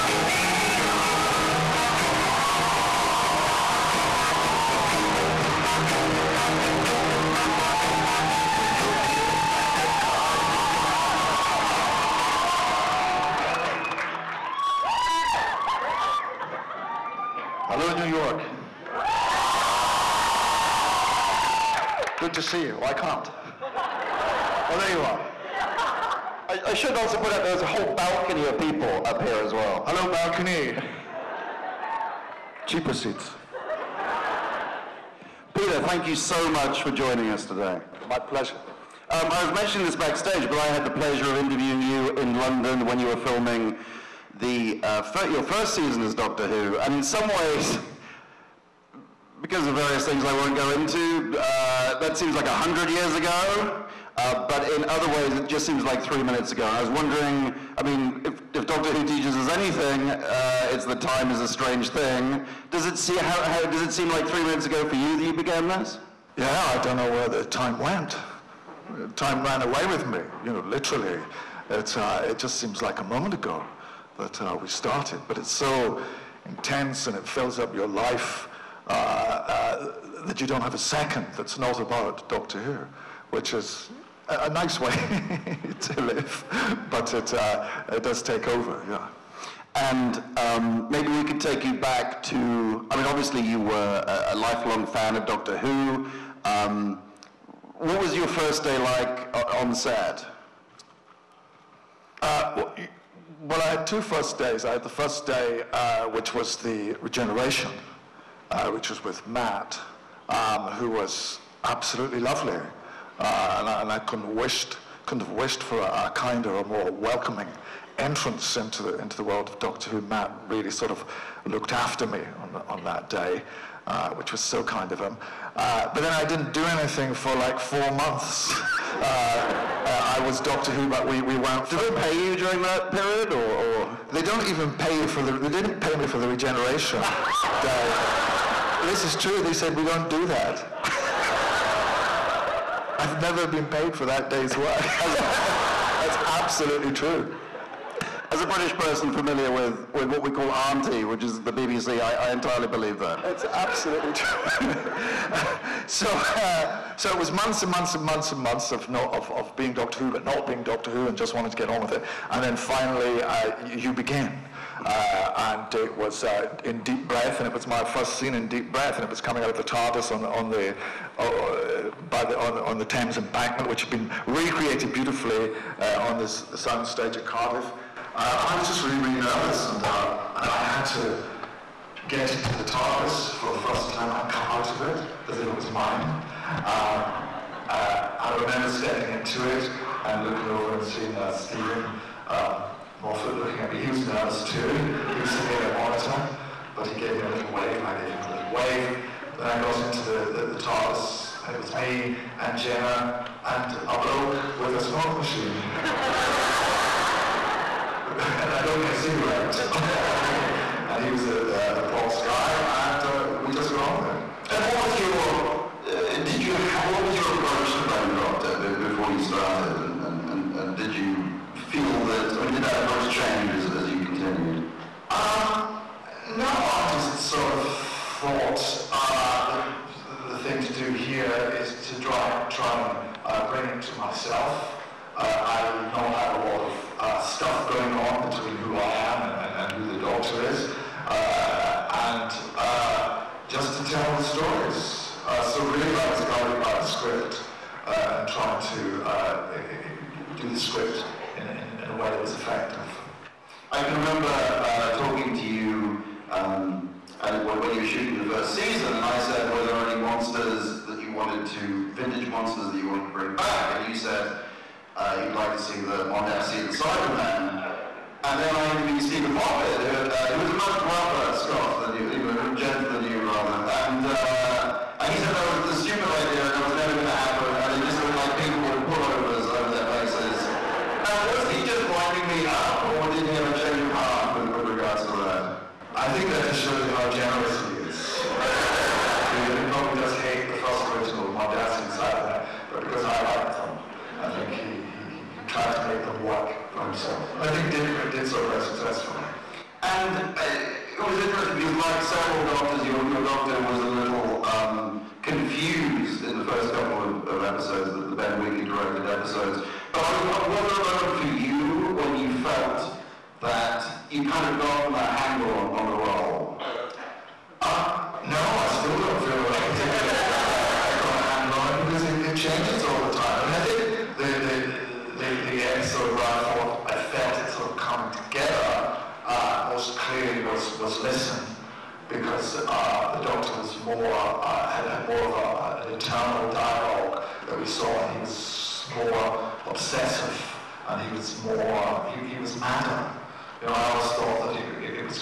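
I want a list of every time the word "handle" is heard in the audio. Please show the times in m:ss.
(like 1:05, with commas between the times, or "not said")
5:15, 5:21.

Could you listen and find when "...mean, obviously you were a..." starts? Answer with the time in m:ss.
1:32.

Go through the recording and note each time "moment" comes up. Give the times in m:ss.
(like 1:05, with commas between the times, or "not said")
1:13, 5:10.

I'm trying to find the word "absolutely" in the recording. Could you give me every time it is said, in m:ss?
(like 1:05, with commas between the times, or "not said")
1:51, 2:26, 2:33.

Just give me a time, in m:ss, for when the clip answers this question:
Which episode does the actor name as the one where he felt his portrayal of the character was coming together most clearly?
5:31.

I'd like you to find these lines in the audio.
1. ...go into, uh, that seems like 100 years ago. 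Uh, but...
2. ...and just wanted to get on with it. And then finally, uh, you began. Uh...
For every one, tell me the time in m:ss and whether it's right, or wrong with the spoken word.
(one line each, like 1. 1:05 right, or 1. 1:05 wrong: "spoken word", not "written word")
1. 0:50 right
2. 2:41 right.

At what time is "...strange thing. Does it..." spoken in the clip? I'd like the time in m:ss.
1:01.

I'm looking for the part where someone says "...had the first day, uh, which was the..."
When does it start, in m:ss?
1:44.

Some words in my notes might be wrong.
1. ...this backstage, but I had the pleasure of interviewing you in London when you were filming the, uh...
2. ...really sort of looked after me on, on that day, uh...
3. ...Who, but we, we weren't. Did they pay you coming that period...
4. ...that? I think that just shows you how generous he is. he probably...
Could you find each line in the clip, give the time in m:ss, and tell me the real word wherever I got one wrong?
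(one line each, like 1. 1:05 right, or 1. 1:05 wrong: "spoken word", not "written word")
1. 0:39 right
2. 2:00 right
3. 2:10 wrong: "during", not "coming"
4. 4:45 right.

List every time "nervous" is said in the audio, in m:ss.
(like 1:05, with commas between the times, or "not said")
2:59, 3:14.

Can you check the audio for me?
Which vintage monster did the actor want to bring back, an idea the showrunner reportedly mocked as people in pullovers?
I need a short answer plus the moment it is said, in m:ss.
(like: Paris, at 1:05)
Cyberman, at 4:26.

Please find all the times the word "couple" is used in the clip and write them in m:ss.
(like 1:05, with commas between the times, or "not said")
5:06.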